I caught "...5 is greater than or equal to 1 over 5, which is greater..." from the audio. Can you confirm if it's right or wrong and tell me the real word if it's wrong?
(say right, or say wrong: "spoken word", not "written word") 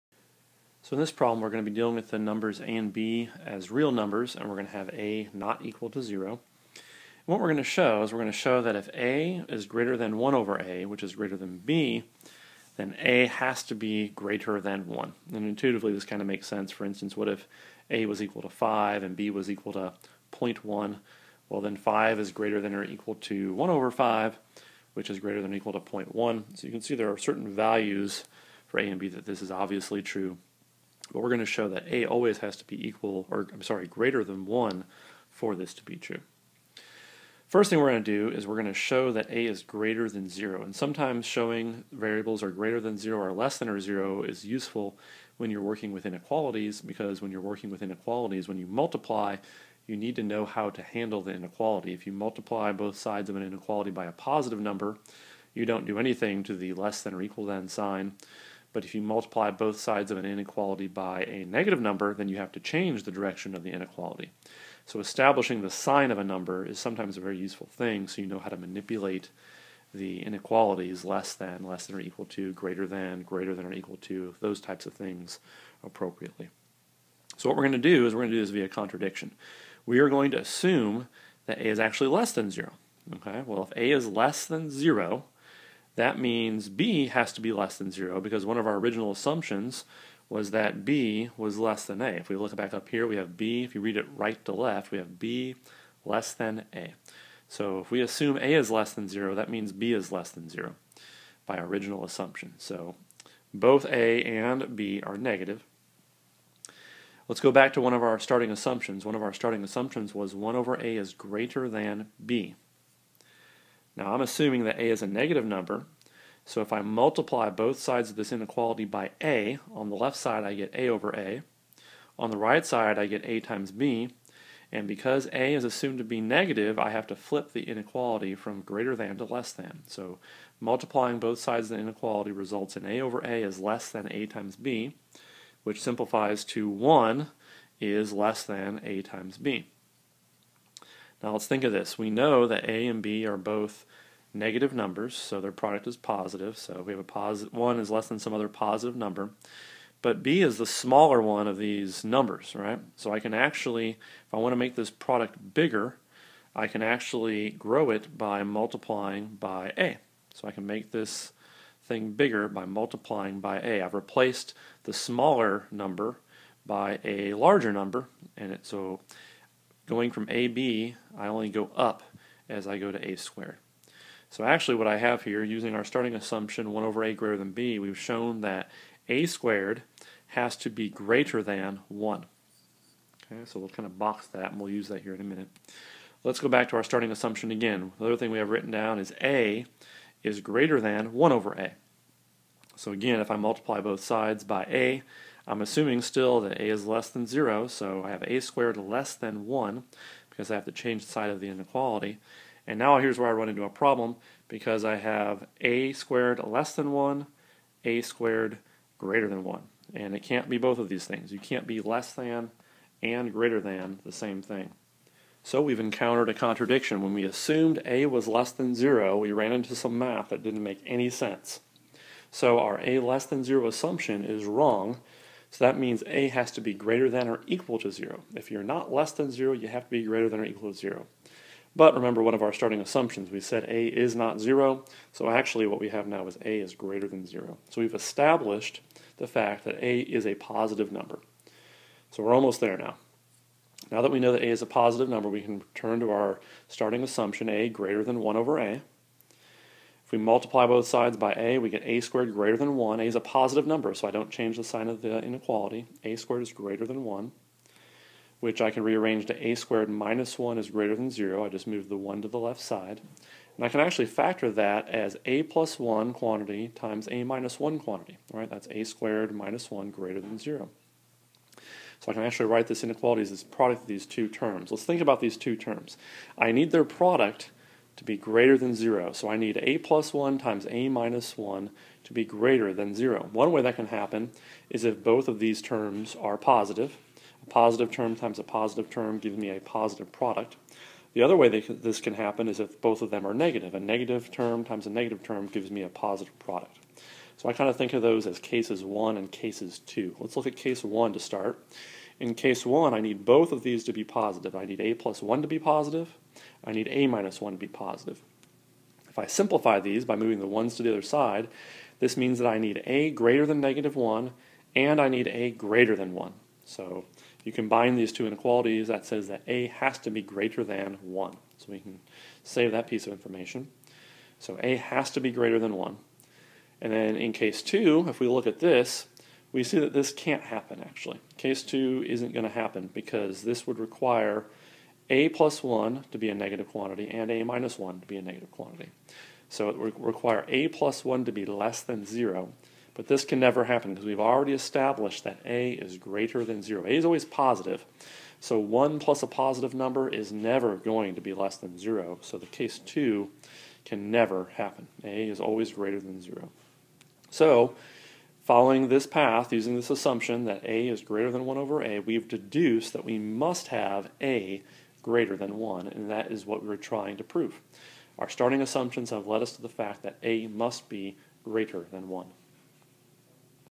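right.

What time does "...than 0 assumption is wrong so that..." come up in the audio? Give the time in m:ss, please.
3:43.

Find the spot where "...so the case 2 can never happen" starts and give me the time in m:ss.
5:52.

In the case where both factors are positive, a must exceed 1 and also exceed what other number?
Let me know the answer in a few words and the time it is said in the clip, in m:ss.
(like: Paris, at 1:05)
-1, at 5:13.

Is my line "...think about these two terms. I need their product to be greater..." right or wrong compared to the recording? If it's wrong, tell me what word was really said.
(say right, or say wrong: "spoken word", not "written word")
right.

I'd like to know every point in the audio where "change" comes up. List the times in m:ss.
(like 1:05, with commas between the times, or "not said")
1:02, 3:20, 4:14.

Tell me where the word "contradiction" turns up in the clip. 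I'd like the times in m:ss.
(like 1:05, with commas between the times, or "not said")
1:18, 3:36.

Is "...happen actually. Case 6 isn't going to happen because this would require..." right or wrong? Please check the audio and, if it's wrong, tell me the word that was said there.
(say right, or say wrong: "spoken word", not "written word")
wrong: "2", not "6".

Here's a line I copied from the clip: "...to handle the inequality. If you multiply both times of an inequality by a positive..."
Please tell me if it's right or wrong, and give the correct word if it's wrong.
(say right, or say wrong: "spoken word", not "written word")
wrong: "sides", not "times".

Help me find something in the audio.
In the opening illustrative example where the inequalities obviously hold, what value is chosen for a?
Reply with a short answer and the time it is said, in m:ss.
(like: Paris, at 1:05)
5, at 0:17.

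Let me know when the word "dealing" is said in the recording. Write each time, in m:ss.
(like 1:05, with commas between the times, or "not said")
0:01.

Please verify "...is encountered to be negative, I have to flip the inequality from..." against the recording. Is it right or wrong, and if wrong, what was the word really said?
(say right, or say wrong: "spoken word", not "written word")
wrong: "assumed", not "encountered".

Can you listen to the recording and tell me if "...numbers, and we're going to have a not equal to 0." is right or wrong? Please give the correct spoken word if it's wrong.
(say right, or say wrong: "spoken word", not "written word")
right.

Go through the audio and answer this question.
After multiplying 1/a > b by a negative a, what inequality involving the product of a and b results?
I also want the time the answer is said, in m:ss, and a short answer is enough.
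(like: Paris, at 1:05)
1 < ab, at 2:16.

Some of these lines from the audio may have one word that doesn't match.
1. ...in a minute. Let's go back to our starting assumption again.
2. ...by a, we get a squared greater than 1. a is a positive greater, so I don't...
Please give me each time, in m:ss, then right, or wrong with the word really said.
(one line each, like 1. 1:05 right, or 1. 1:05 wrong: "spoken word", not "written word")
1. 3:05 right
2. 4:11 wrong: "number", not "greater".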